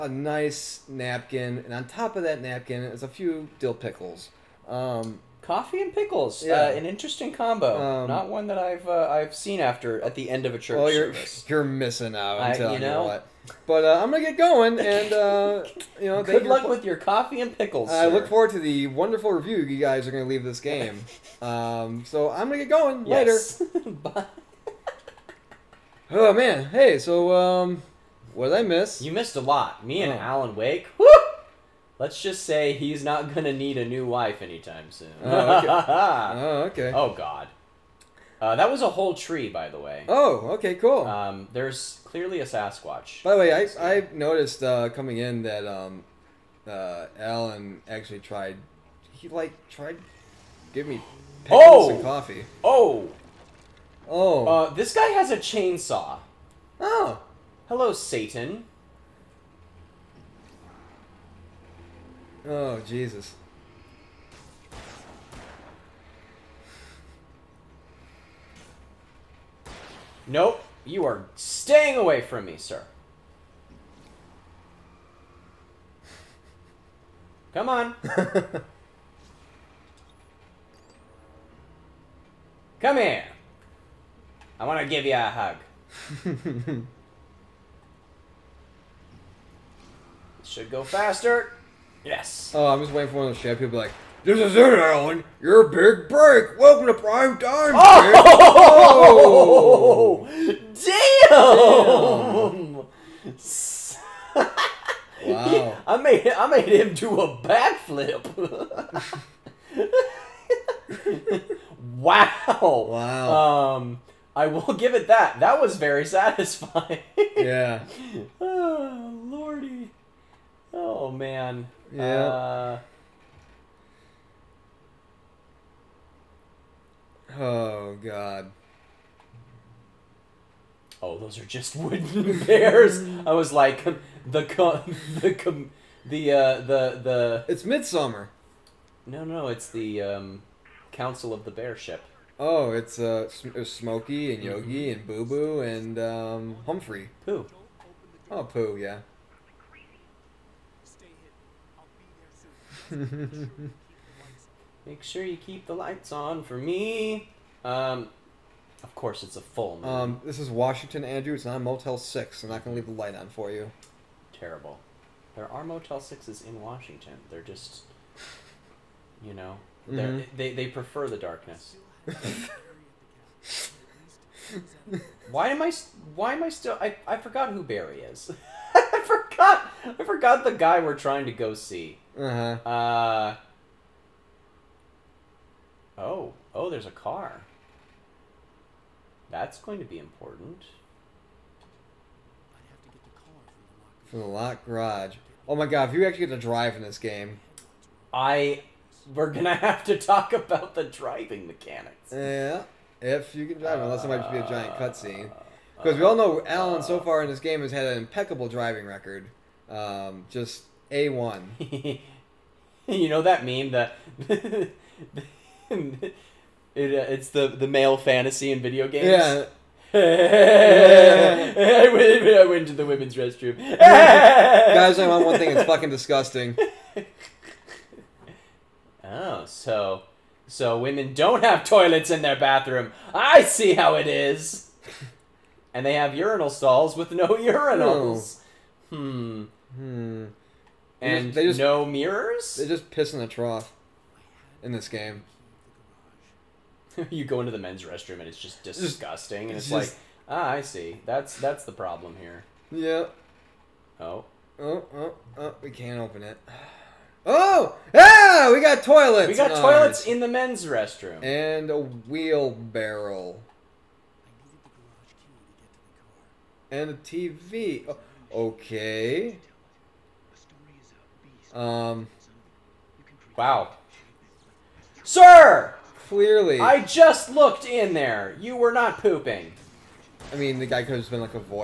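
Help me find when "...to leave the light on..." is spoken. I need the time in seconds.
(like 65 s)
162 s.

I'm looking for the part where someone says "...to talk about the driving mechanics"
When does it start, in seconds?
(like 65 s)
199 s.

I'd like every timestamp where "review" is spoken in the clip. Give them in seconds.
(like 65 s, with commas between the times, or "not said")
19 s.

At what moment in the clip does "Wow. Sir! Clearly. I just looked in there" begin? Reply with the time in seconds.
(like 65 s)
273 s.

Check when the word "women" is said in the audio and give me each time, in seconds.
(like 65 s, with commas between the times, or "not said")
222 s, 230 s.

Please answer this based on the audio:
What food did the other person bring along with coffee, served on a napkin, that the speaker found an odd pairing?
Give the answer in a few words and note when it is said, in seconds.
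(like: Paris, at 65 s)
Dill pickles, at 3 s.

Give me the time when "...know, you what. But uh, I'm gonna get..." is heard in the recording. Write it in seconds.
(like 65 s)
12 s.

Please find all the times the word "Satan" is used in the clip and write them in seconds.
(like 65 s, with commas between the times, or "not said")
57 s.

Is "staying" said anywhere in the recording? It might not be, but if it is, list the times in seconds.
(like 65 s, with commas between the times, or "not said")
71 s.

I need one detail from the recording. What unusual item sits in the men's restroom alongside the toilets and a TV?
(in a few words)
A wheelbarrow.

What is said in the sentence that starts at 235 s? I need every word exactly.
and they have urinal stalls with no urinals.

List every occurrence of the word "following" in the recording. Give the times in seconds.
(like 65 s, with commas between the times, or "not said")
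not said.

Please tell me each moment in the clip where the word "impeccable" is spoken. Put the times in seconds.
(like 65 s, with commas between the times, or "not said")
207 s.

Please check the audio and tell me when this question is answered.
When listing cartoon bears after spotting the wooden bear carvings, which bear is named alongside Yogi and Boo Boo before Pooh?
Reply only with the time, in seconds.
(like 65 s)
146 s.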